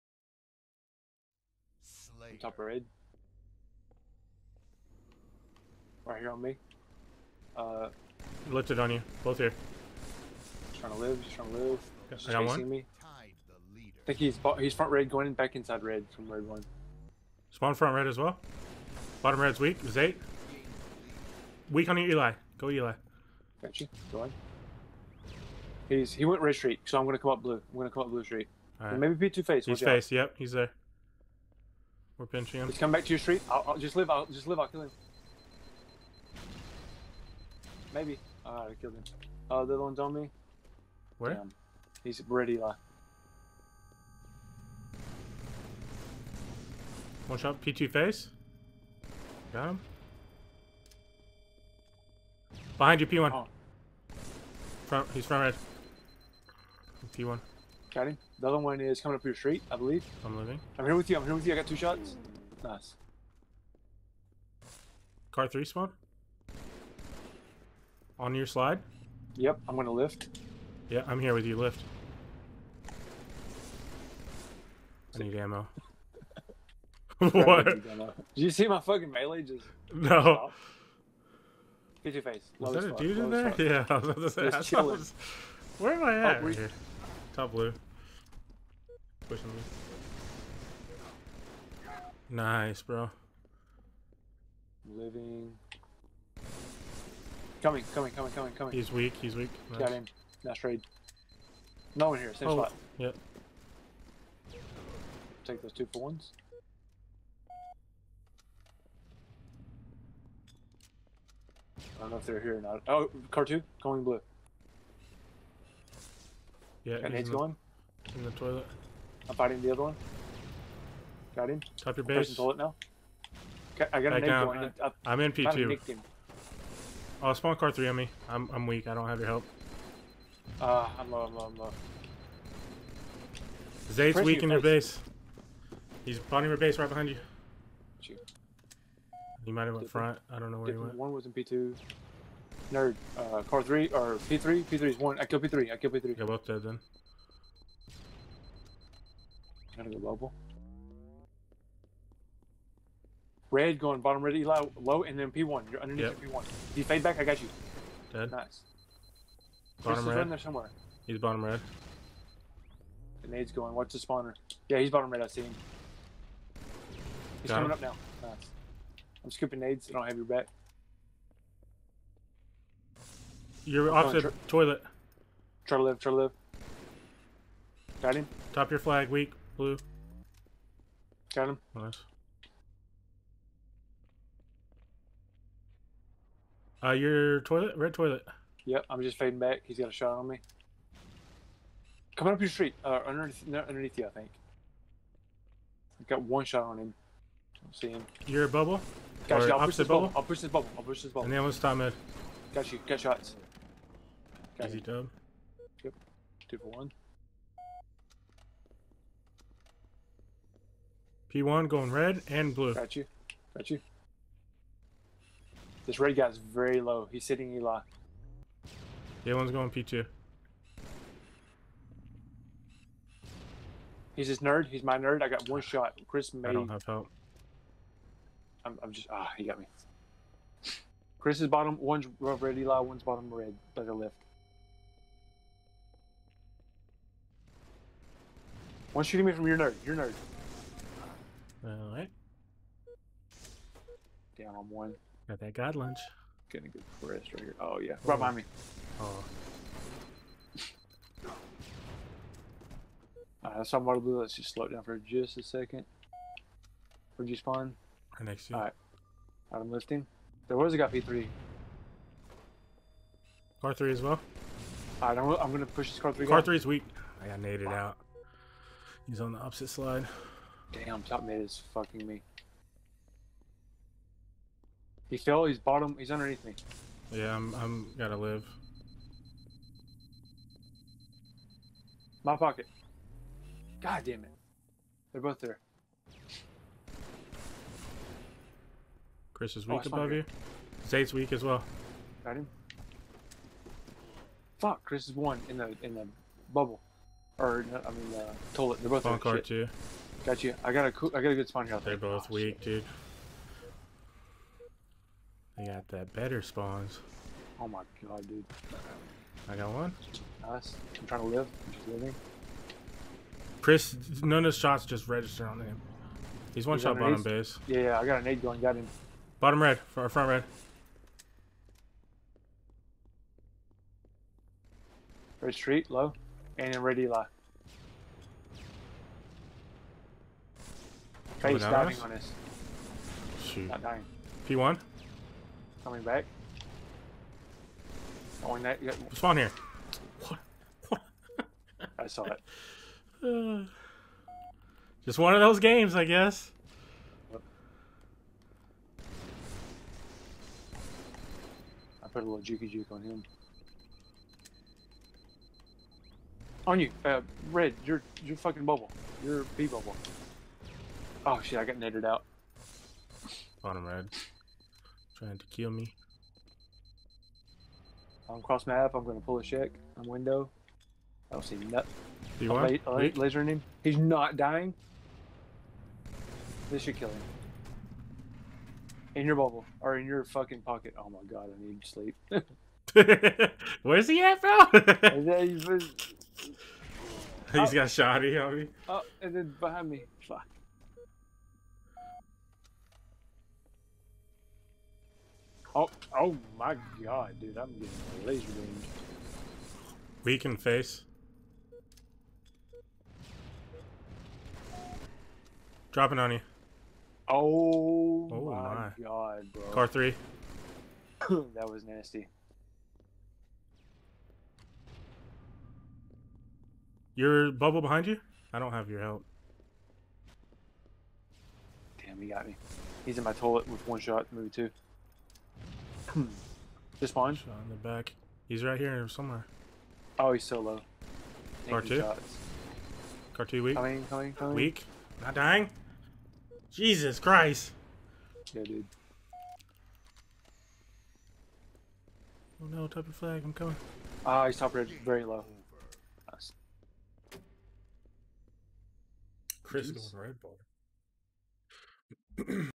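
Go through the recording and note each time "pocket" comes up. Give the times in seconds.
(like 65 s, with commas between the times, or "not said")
282 s, 380 s.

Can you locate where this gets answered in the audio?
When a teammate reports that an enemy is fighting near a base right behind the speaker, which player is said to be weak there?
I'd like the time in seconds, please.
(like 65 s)
133 s.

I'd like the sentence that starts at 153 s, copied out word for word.
Red going bottom red, Eli low, and then P1.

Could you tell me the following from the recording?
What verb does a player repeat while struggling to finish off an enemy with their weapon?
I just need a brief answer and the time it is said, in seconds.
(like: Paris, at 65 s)
lasering, at 372 s.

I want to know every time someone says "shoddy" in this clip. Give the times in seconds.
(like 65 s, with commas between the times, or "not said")
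387 s.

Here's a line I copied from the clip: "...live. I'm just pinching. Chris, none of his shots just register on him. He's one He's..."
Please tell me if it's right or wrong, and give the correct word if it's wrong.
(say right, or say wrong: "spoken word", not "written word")
wrong: "living", not "pinching".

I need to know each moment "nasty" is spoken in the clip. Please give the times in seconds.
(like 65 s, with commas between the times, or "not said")
411 s.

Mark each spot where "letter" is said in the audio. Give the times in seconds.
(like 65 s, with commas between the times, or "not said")
not said.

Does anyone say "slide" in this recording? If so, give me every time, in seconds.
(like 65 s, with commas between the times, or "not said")
68 s, 269 s.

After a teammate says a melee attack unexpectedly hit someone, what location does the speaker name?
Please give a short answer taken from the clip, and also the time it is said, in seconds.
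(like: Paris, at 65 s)
Top blue, at 87 s.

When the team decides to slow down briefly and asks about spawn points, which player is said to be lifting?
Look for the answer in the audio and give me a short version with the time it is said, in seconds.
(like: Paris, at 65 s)
Adam, at 259 s.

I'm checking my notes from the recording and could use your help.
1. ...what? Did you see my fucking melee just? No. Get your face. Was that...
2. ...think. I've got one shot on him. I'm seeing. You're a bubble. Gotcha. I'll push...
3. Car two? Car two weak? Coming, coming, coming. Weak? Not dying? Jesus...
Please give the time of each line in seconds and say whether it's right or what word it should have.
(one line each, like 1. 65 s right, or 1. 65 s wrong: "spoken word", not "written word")
1. 77 s right
2. 194 s right
3. 431 s right.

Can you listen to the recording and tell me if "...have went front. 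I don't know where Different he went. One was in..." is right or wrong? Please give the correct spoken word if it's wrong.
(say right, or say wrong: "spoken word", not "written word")
right.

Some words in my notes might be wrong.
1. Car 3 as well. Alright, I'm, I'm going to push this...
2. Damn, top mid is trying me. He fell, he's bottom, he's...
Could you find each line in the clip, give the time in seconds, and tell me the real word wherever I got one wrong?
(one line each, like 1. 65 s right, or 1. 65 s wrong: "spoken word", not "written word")
1. 263 s right
2. 270 s wrong: "fucking", not "trying".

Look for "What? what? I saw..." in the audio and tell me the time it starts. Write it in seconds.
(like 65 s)
340 s.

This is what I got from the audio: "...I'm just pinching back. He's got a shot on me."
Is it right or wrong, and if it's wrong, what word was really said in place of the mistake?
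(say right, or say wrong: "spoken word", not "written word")
wrong: "fading", not "pinching".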